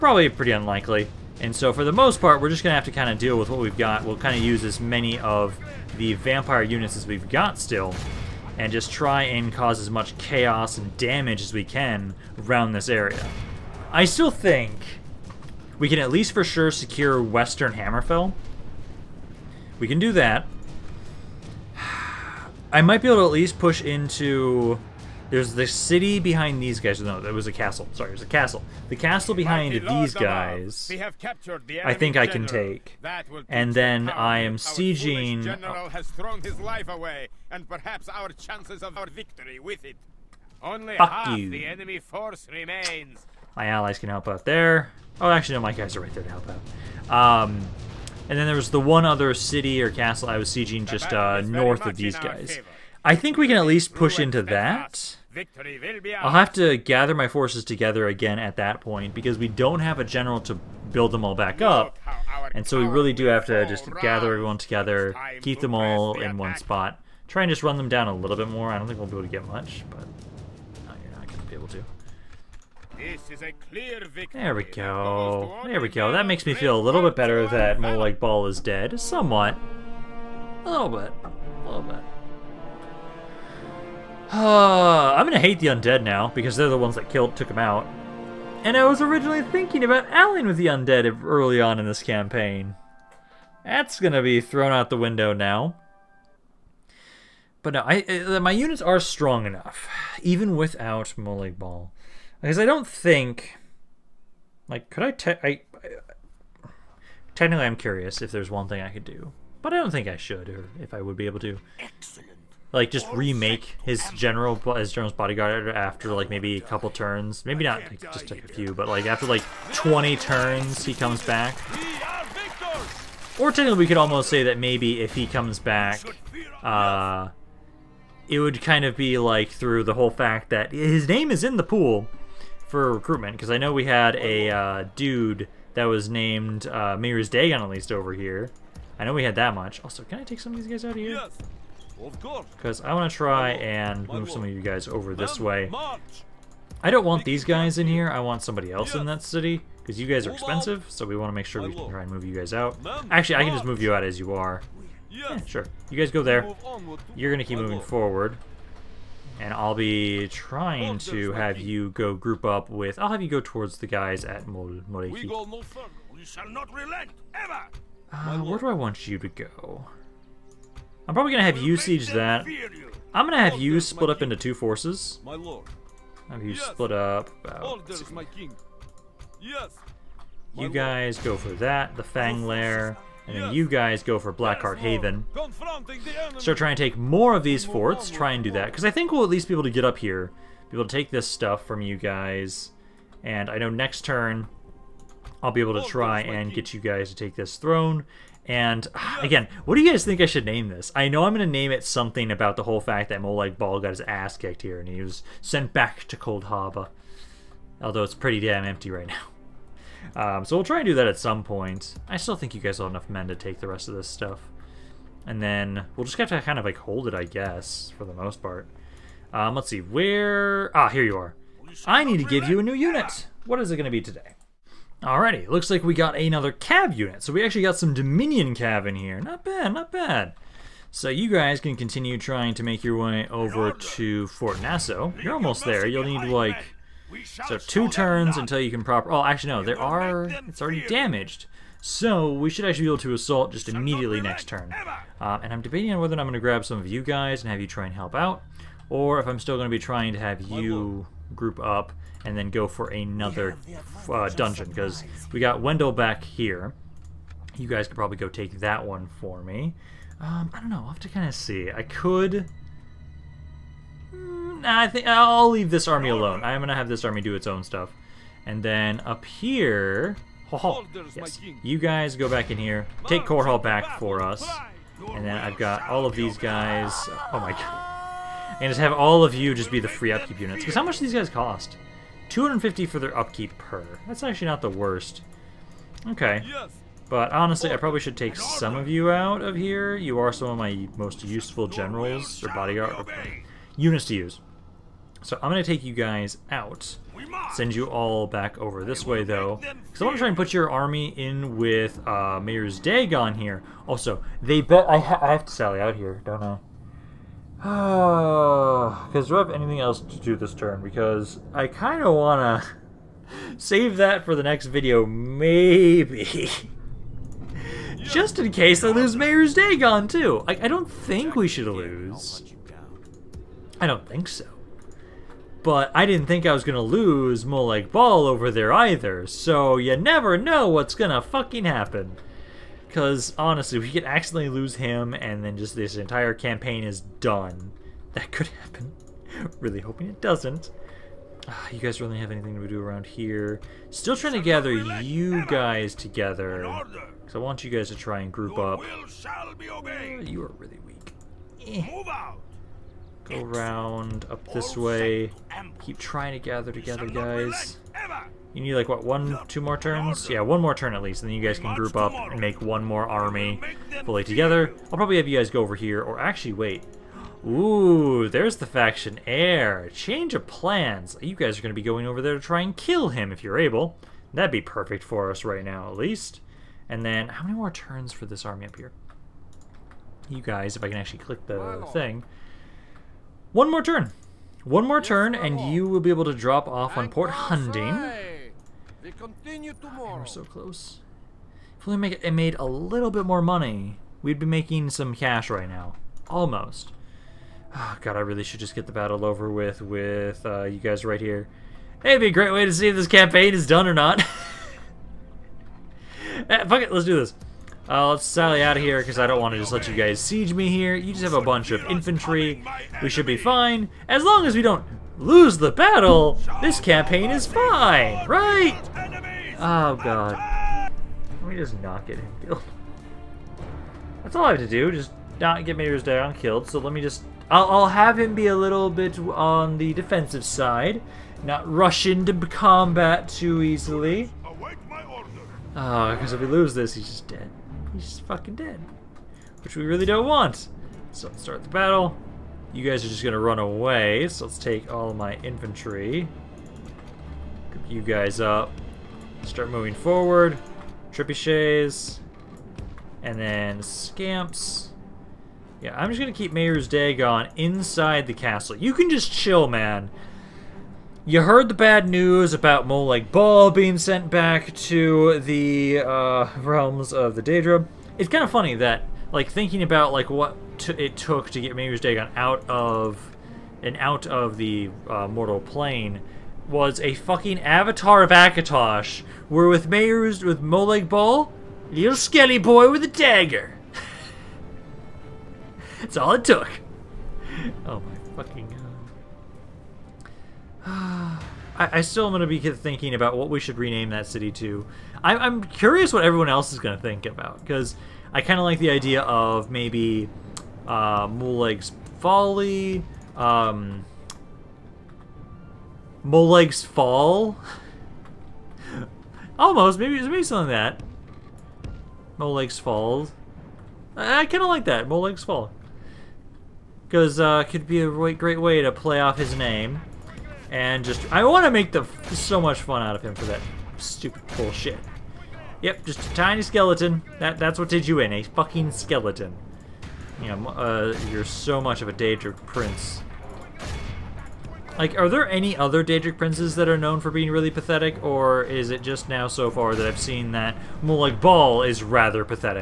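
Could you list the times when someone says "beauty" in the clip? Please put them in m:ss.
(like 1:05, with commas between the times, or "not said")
not said.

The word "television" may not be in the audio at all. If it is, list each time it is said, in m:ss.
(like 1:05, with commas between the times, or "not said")
not said.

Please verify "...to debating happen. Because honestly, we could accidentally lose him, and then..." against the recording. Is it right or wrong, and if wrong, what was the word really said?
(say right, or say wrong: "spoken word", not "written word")
wrong: "fucking", not "debating".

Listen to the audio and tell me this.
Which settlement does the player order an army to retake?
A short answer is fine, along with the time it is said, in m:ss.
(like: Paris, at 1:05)
Korhal, at 4:33.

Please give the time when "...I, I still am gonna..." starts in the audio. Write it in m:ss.
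8:11.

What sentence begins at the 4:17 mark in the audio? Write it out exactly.
You guys could probably go take that one for me.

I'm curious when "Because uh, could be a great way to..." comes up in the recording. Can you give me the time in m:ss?
8:37.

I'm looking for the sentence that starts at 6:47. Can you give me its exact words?
Uh, let's sally out of here because I don't want to just let you guys siege me here.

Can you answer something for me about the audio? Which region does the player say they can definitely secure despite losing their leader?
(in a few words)
Western Hammerfell.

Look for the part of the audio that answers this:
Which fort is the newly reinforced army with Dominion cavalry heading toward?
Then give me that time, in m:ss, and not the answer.
3:54.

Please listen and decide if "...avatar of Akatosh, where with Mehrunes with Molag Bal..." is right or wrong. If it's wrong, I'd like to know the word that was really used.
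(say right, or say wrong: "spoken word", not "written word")
right.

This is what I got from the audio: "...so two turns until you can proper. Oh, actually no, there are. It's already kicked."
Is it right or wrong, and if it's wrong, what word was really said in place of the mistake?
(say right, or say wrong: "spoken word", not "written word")
wrong: "damaged", not "kicked".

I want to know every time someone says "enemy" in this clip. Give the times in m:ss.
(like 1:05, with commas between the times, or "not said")
0:41.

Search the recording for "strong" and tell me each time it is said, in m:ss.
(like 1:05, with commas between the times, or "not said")
1:38.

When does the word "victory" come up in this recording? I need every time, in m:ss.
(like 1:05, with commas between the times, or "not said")
0:39, 1:14.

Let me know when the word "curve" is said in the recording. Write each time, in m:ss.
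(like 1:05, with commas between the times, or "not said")
not said.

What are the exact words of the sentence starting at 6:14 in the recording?
That'd be perfect for us right now, at least.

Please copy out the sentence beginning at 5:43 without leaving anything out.
Still trying to gather you guys together.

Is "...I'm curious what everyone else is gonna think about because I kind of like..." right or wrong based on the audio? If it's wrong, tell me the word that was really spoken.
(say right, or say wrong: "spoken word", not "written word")
right.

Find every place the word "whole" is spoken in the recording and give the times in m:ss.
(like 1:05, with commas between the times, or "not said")
2:09, 3:22.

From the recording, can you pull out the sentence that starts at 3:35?
And then we'll just have to kind of like hold it, I guess, for the most part.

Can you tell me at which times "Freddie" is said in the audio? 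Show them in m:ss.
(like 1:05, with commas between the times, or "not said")
not said.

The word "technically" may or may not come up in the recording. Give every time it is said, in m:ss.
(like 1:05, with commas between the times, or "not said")
1:47, 2:03.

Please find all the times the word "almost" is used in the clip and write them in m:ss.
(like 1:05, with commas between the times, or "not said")
2:03, 3:55, 6:36, 8:29.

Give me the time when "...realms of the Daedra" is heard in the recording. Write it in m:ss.
7:46.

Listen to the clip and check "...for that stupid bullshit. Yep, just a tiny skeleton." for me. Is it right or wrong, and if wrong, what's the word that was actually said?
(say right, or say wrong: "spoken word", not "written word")
right.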